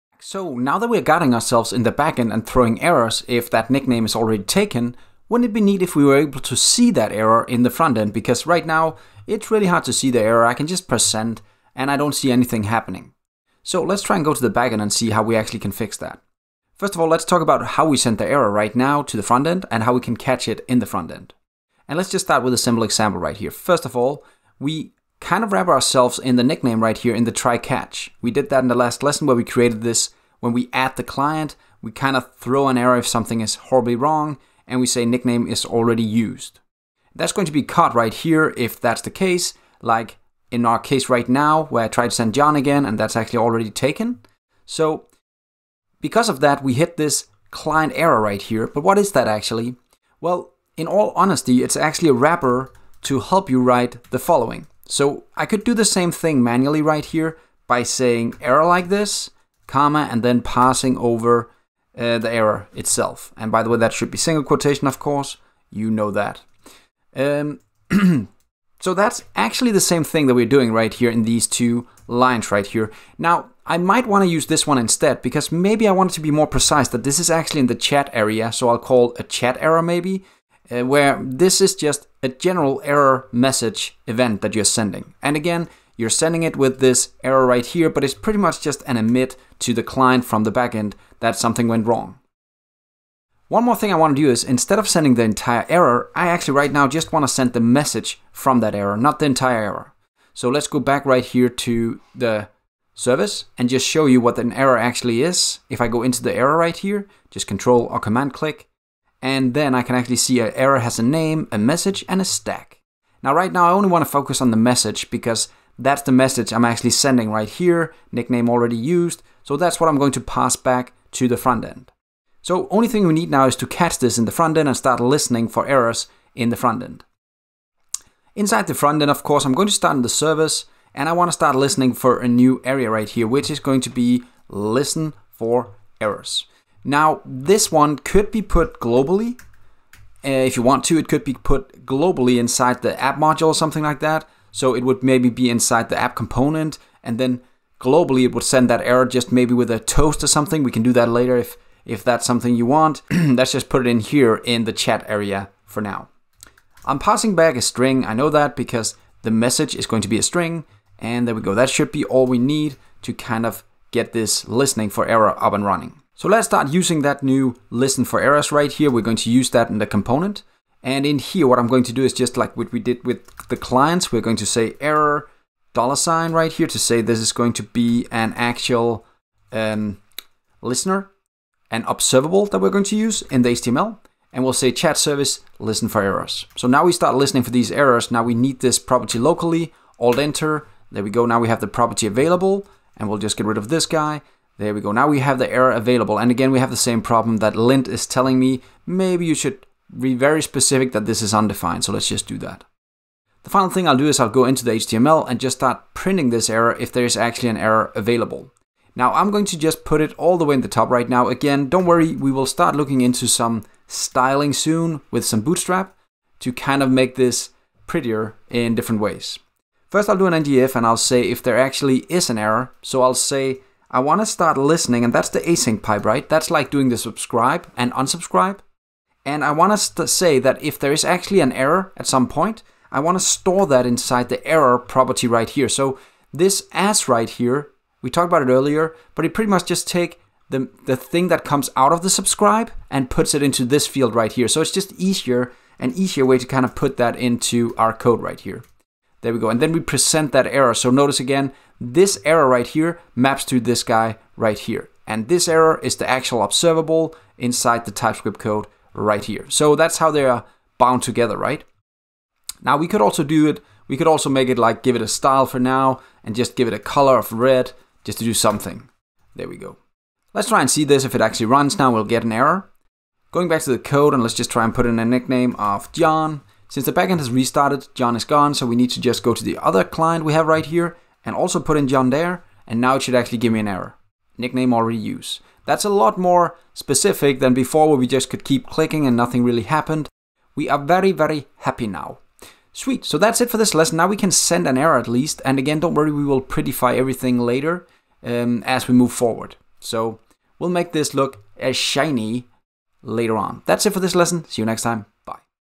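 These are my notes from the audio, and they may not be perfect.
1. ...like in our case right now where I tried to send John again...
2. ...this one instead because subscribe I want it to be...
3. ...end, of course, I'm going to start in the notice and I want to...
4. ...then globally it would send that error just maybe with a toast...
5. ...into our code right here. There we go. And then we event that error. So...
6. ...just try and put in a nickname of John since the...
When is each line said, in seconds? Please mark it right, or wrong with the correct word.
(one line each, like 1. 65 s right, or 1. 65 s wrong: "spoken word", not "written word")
1. 39 s right
2. 74 s wrong: "maybe", not "subscribe"
3. 129 s wrong: "service", not "notice"
4. 147 s right
5. 247 s wrong: "present", not "event"
6. 274 s right.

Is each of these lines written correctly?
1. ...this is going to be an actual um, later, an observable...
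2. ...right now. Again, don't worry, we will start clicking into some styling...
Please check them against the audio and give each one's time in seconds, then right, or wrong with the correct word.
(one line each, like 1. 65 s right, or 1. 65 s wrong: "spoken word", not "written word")
1. 177 s wrong: "listener", not "later"
2. 210 s wrong: "looking", not "clicking".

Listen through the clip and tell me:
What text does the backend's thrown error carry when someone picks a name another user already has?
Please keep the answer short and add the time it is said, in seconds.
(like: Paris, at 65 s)
Nickname is already used, at 35 s.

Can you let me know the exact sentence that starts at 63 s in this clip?
And by the way, that should be single quotation, of course.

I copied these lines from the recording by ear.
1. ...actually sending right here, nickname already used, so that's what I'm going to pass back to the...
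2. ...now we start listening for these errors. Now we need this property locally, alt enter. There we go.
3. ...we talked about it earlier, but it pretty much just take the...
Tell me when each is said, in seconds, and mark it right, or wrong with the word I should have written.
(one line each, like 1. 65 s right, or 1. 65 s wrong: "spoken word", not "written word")
1. 116 s right
2. 186 s right
3. 238 s right.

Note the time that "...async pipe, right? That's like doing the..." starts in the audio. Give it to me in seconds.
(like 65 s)
225 s.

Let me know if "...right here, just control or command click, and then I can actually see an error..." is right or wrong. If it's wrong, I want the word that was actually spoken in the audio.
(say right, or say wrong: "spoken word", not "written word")
right.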